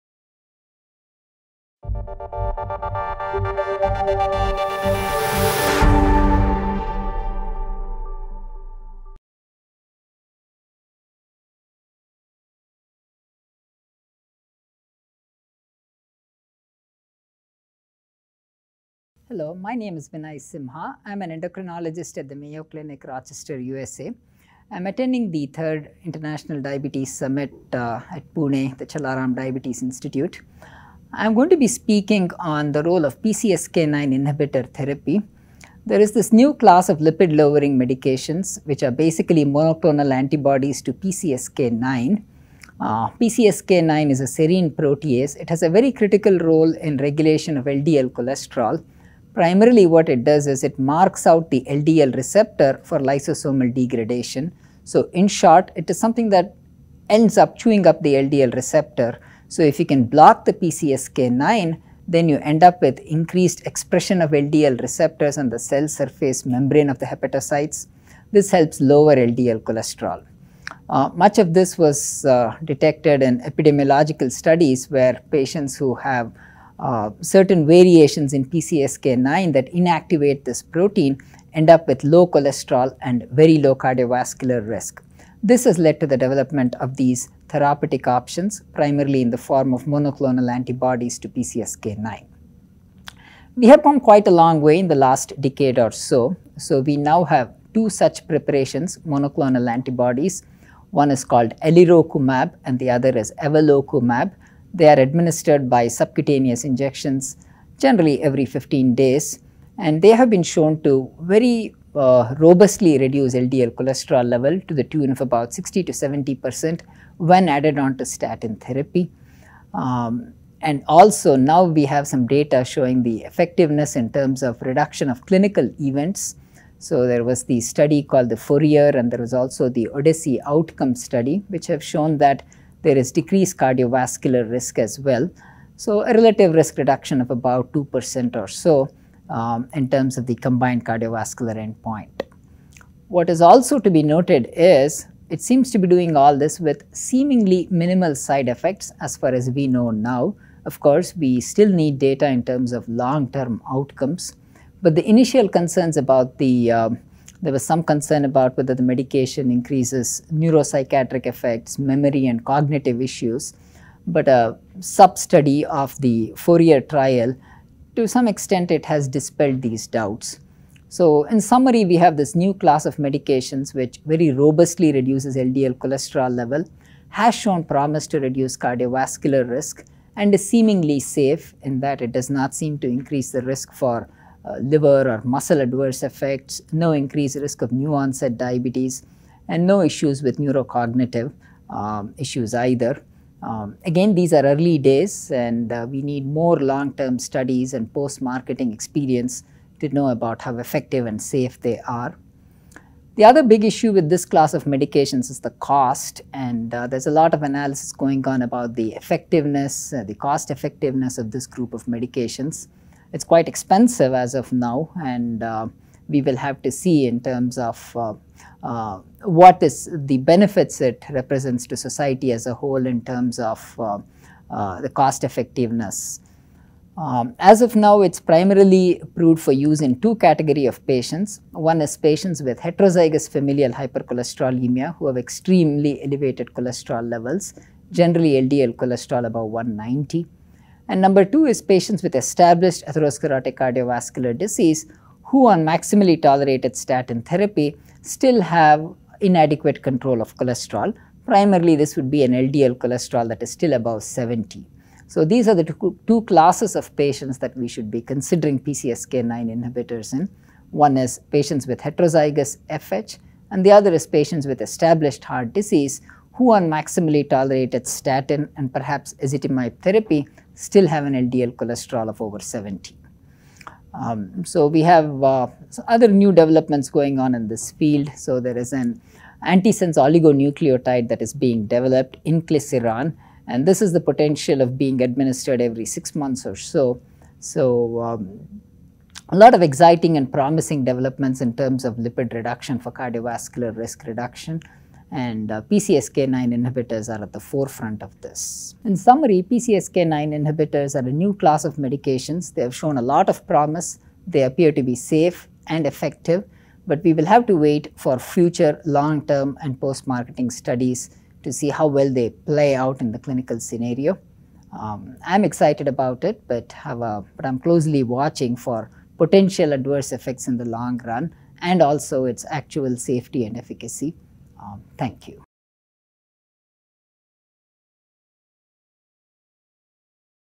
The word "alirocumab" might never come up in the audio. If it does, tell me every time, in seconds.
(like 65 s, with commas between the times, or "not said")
101 s.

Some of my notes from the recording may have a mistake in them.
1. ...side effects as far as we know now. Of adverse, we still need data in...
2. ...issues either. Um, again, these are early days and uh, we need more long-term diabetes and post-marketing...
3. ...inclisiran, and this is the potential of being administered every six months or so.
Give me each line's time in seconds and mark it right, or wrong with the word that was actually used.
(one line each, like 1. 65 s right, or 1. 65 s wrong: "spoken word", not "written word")
1. 148 s wrong: "course", not "adverse"
2. 192 s wrong: "studies", not "diabetes"
3. 282 s right.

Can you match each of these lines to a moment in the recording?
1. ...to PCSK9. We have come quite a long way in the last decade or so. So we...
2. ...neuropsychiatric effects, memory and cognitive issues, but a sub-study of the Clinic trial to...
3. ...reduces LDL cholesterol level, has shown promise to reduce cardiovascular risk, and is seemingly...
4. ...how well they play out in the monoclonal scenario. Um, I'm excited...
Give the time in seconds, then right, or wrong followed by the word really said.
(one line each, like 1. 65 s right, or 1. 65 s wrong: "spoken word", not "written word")
1. 91 s right
2. 160 s wrong: "Fourier", not "Clinic"
3. 174 s right
4. 311 s wrong: "clinical", not "monoclonal".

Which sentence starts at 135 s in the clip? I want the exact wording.
So a relative risk reduction of about 2% or so um, in terms of the combined cardiovascular endpoint.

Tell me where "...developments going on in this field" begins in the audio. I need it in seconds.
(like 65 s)
276 s.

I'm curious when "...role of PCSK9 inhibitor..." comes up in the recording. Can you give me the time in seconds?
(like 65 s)
32 s.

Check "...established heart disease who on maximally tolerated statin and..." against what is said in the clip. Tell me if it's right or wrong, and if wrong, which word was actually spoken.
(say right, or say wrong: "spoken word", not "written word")
right.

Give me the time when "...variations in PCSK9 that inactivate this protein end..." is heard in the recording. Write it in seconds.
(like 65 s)
77 s.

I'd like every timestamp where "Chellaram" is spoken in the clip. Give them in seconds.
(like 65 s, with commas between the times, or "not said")
28 s.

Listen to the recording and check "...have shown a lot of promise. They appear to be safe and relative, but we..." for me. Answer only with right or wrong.
wrong.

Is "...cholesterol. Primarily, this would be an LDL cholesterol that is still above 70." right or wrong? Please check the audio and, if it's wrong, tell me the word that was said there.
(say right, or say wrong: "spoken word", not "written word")
right.